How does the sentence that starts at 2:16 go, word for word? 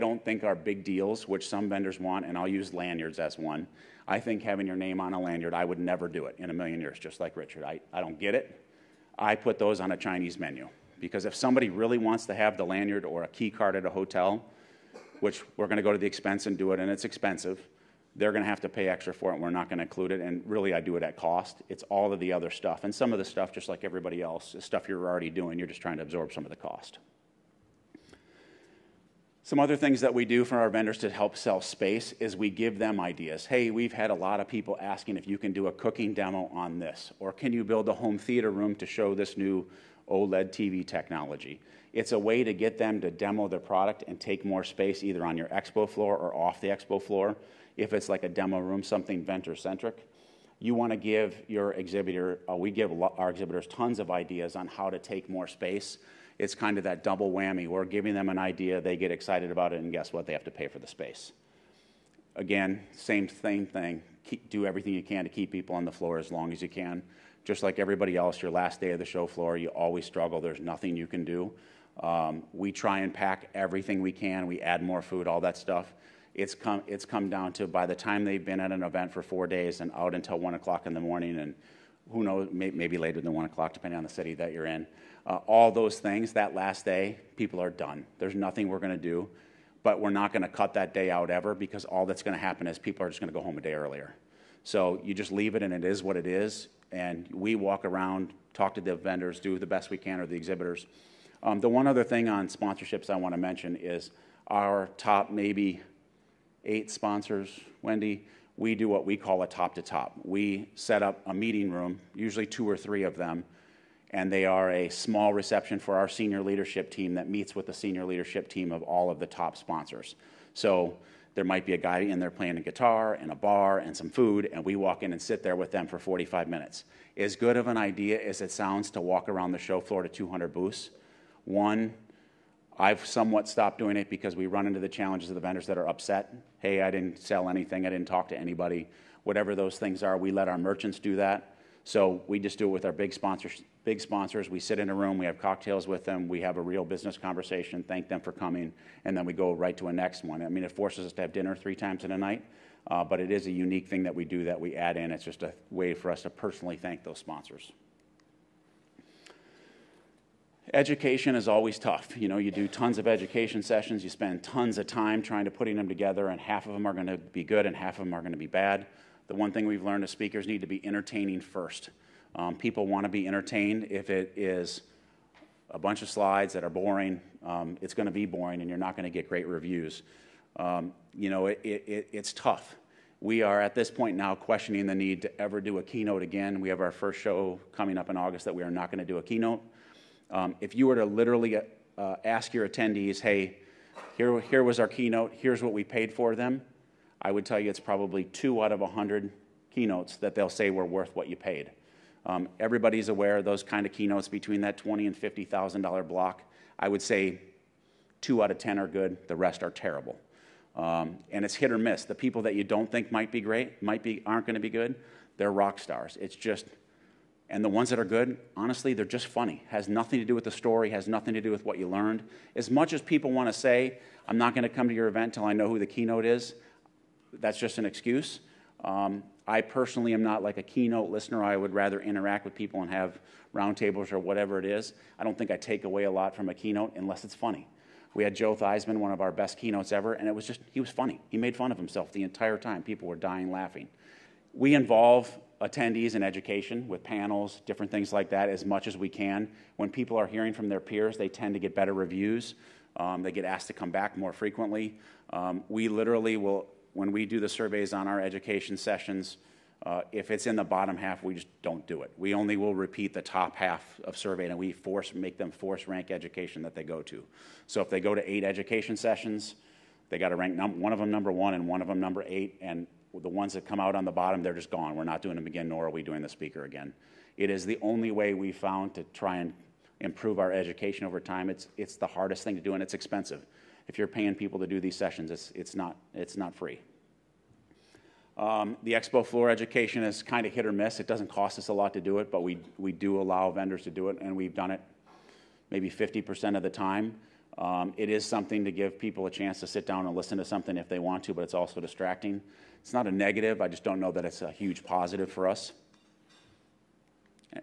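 Hey, I didn't sell anything, I didn't talk to anybody.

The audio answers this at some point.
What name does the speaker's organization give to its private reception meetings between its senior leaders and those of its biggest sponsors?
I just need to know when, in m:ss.
1:49.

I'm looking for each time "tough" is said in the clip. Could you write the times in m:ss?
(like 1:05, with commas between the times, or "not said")
2:41, 3:02.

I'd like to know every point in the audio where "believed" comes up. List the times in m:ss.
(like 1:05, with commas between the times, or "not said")
not said.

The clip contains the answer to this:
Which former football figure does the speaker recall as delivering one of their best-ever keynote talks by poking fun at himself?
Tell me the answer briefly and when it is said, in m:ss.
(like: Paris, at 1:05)
Joe Theismann, at 3:58.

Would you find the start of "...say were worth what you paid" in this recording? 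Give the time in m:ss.
3:20.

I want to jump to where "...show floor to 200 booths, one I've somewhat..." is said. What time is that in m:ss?
2:09.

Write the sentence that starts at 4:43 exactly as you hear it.
If you're paying people to do these sessions, it's, it's, not, it's not free.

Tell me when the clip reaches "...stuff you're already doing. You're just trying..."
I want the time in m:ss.
0:24.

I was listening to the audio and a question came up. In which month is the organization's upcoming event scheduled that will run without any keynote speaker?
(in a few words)
August.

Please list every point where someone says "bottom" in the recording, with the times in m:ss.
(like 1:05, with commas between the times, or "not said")
4:20, 4:34.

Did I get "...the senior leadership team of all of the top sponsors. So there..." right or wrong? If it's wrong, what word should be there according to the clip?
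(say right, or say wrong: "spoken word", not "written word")
right.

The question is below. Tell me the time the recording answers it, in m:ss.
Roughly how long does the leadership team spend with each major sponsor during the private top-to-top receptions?
2:05.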